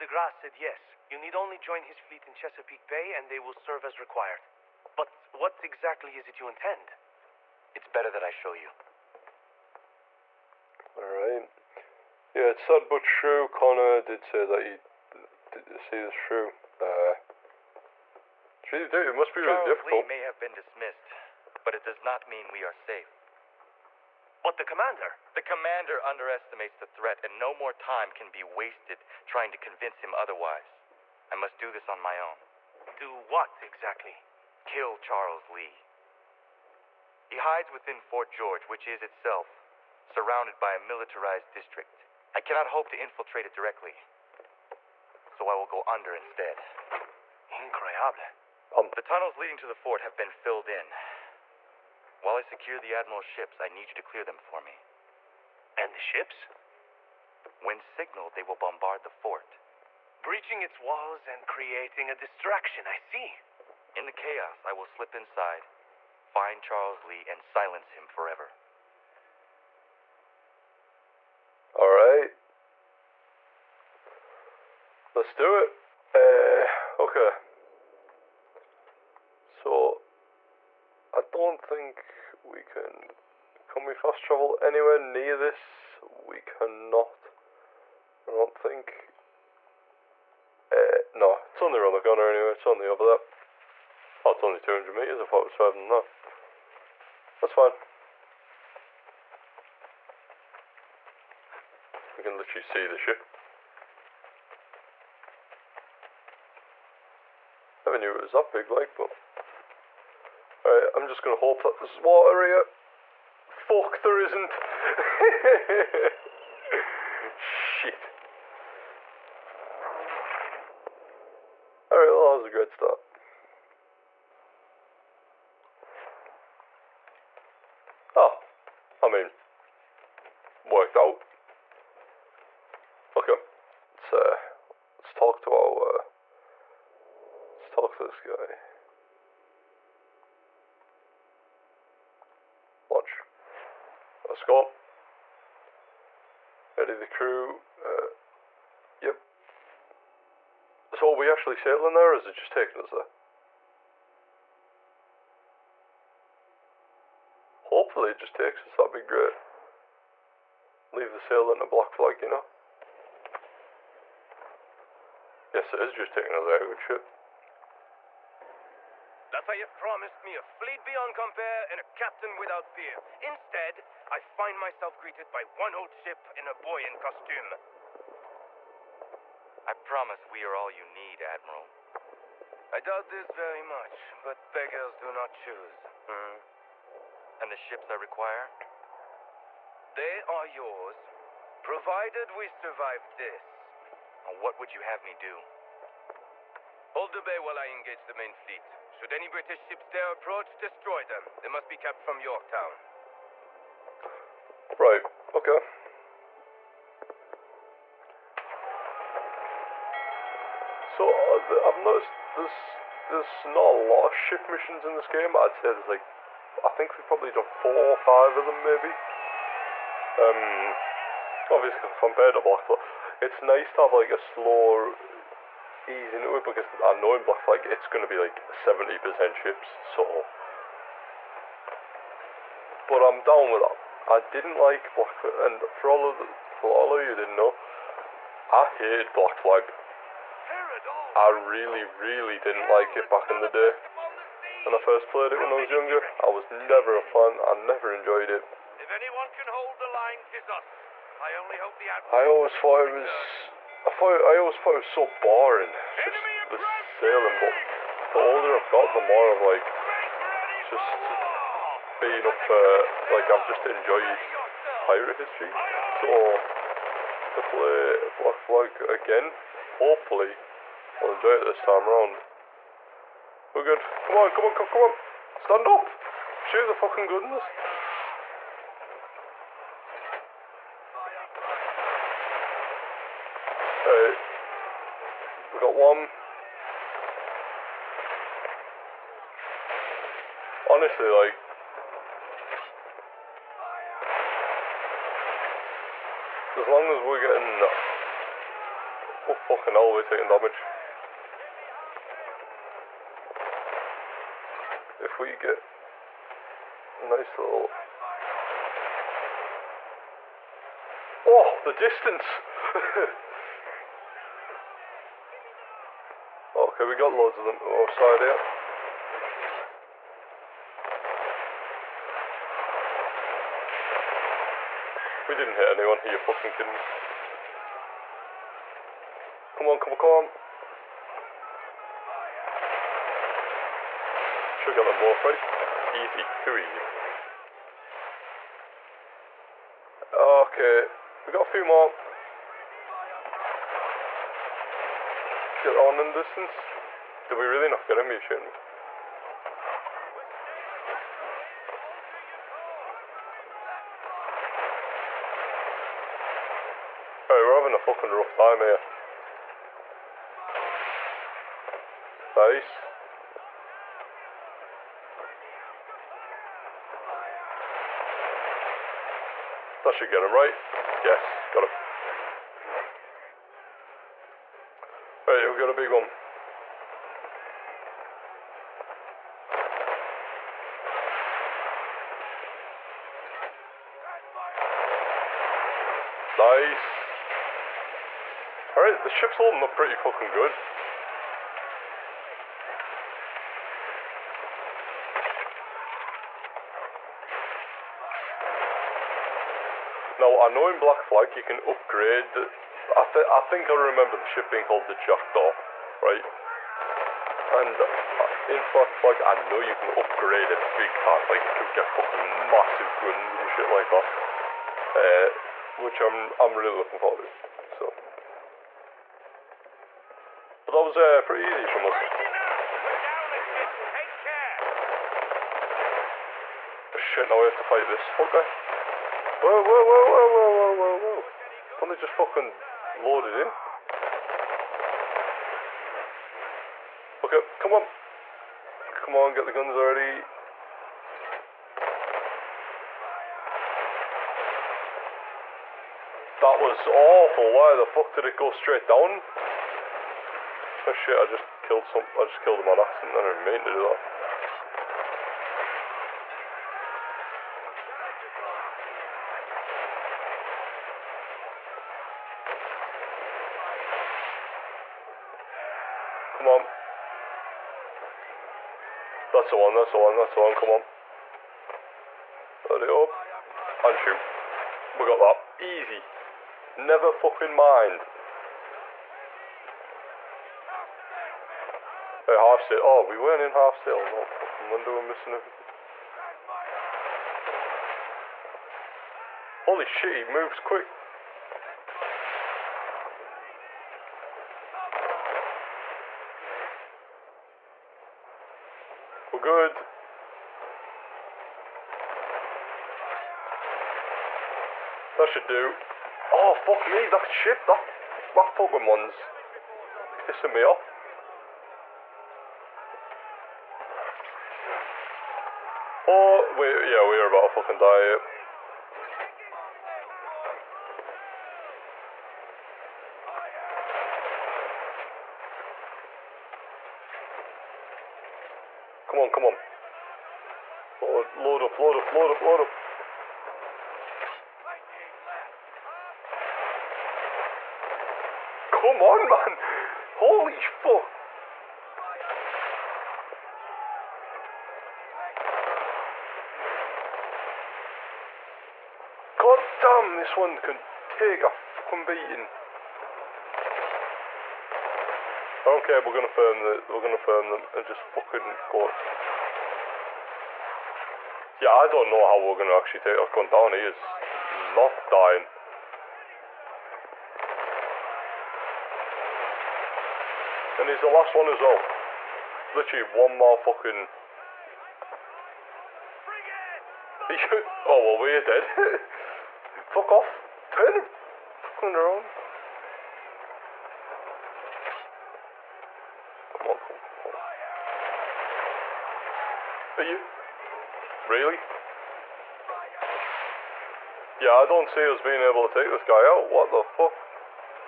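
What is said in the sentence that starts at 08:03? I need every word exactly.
Oh, no fucking wonder we're missing everything.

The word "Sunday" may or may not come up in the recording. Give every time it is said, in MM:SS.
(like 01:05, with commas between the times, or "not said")
not said.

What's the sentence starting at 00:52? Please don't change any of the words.
While I secure the Admiral's ships, I need you to clear them for me.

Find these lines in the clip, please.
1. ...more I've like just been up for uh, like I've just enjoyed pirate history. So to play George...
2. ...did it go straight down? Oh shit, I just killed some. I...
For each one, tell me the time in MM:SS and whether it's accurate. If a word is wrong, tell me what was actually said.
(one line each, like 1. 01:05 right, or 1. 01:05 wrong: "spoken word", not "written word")
1. 04:19 wrong: "Black", not "George"
2. 07:28 right.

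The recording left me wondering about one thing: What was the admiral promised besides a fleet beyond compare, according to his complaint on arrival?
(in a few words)
A captain without peer.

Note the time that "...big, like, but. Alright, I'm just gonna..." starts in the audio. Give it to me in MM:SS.
01:48.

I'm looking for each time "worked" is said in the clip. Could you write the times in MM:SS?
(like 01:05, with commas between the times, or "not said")
02:10.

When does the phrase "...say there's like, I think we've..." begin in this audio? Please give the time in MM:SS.
03:35.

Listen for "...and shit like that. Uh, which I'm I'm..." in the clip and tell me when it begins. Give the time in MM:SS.
06:53.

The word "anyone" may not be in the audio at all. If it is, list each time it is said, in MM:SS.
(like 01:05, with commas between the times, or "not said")
04:08, 05:25.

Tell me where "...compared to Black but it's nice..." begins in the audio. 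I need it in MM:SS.
03:41.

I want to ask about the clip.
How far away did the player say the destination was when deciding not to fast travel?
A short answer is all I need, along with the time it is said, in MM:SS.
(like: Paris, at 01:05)
200 meters, at 01:34.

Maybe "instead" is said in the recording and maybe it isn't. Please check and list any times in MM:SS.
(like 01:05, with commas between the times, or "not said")
00:46, 02:53.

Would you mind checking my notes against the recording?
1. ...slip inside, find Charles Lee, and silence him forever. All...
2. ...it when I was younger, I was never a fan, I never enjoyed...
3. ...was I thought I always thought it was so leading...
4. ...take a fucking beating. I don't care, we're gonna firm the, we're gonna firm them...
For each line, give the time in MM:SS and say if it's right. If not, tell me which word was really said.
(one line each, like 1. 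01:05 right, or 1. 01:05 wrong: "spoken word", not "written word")
1. 01:04 right
2. 04:05 right
3. 04:12 wrong: "boring", not "leading"
4. 09:11 right.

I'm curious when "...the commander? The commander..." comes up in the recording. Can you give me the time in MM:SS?
00:24.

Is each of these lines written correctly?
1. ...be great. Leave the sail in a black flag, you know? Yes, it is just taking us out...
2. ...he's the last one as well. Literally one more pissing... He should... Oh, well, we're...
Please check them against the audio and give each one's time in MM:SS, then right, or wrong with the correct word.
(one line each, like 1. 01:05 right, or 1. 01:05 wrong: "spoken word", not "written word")
1. 02:38 right
2. 09:30 wrong: "fucking", not "pissing".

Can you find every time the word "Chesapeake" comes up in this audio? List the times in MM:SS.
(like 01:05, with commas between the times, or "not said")
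00:02.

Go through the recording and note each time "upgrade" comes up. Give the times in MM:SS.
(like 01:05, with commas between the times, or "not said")
06:41, 06:49.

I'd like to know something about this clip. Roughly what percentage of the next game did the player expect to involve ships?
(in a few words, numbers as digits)
70%.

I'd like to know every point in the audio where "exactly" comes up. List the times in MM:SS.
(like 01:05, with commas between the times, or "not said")
00:05, 00:33.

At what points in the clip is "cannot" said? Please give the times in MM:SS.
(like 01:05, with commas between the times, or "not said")
00:42, 01:26.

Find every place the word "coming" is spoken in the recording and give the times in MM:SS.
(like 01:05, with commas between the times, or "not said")
not said.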